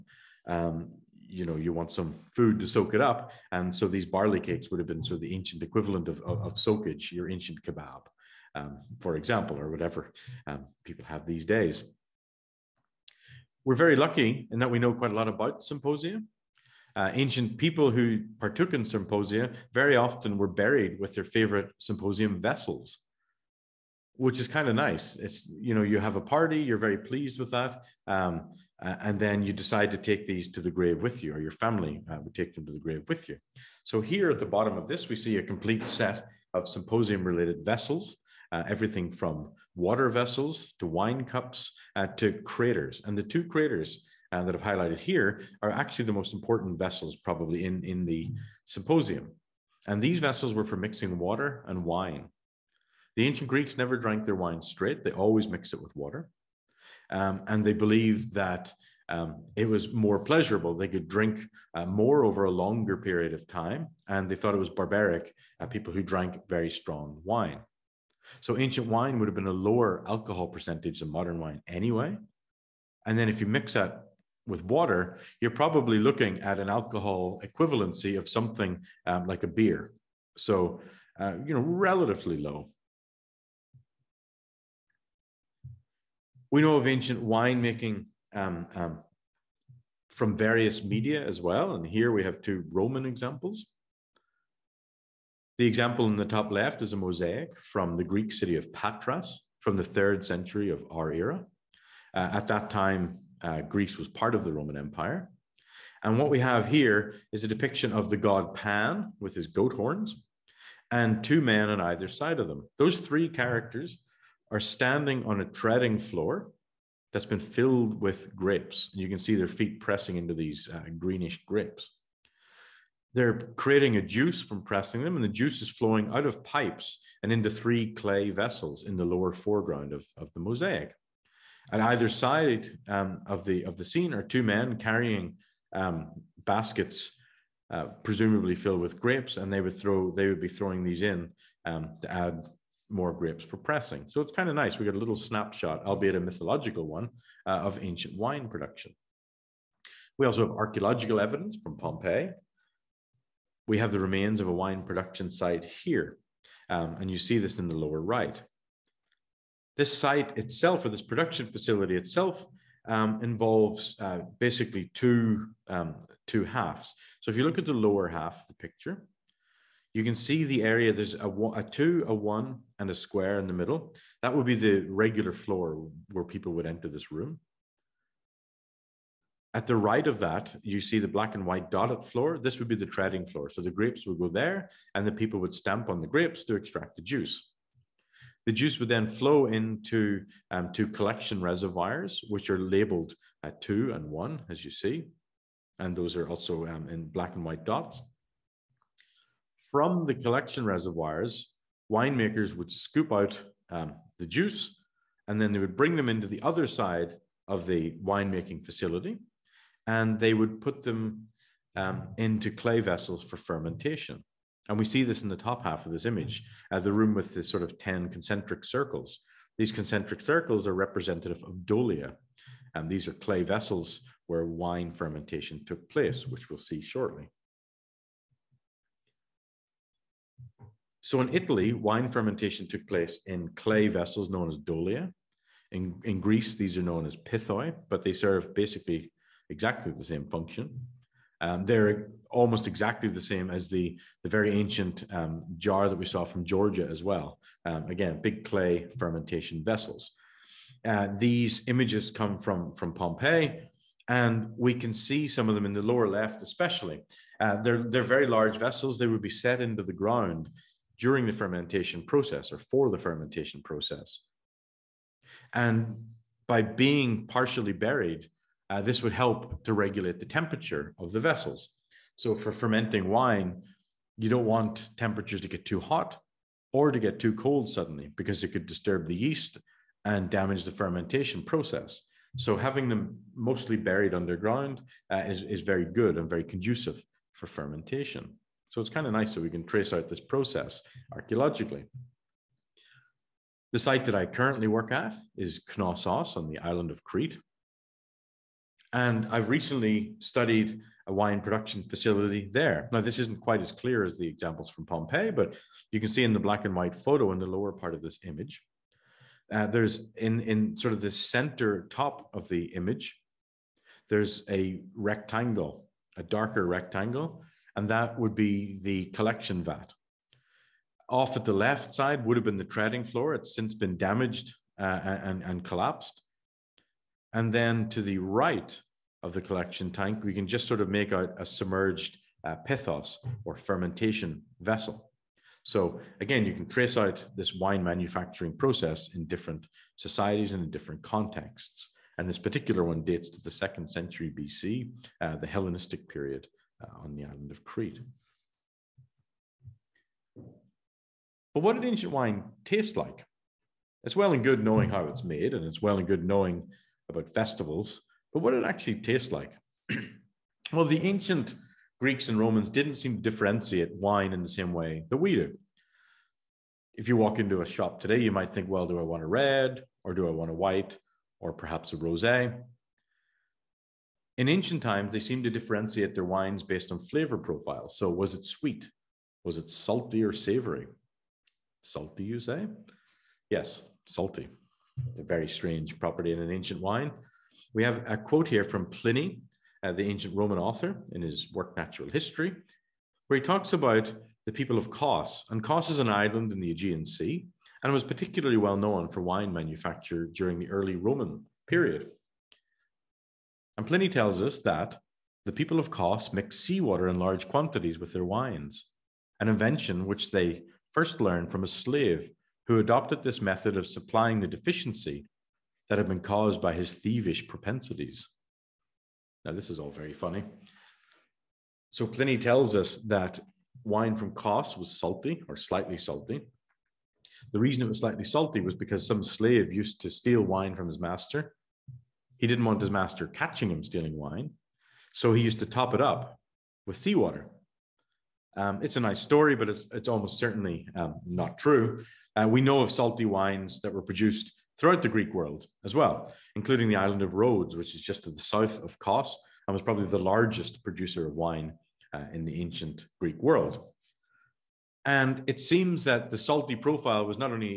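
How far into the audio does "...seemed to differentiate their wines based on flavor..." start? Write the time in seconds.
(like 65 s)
375 s.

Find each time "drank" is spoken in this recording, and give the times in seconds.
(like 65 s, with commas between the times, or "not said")
53 s, 66 s.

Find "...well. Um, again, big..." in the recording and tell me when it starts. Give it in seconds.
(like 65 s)
247 s.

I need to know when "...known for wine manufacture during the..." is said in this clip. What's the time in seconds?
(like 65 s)
398 s.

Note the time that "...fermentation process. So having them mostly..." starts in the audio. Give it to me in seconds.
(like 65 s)
280 s.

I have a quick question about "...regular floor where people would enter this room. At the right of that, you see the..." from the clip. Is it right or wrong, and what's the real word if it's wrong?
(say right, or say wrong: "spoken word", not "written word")
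right.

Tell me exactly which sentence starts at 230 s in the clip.
So in Italy, wine fermentation took place in clay vessels known as dolia.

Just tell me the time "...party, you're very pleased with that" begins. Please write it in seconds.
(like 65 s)
26 s.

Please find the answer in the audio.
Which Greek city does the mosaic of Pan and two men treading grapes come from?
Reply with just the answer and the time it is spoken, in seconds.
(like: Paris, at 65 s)
Patras, at 98 s.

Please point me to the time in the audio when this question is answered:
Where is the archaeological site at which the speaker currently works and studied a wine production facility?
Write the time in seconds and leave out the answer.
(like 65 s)
295 s.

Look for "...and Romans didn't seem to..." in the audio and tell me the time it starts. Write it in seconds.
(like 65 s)
362 s.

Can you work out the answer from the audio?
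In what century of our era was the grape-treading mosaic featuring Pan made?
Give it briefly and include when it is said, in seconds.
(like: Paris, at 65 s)
third century, at 99 s.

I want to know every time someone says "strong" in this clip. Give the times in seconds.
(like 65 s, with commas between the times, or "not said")
66 s.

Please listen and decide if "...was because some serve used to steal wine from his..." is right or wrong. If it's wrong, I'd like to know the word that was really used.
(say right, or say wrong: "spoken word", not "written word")
wrong: "slave", not "serve".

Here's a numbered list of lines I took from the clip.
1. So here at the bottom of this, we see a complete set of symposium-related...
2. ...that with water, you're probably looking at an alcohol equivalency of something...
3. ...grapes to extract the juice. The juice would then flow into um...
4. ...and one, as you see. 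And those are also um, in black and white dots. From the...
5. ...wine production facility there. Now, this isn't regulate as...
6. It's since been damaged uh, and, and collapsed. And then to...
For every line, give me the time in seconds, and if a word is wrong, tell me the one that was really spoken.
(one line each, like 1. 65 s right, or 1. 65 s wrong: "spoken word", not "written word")
1. 33 s right
2. 73 s right
3. 186 s right
4. 193 s right
5. 301 s wrong: "quite", not "regulate"
6. 323 s right.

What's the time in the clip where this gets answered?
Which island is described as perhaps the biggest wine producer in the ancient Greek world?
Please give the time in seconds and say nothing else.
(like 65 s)
447 s.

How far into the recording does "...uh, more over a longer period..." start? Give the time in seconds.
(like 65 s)
61 s.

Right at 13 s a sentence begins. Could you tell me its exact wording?
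We're very lucky in that we know quite a lot about symposium.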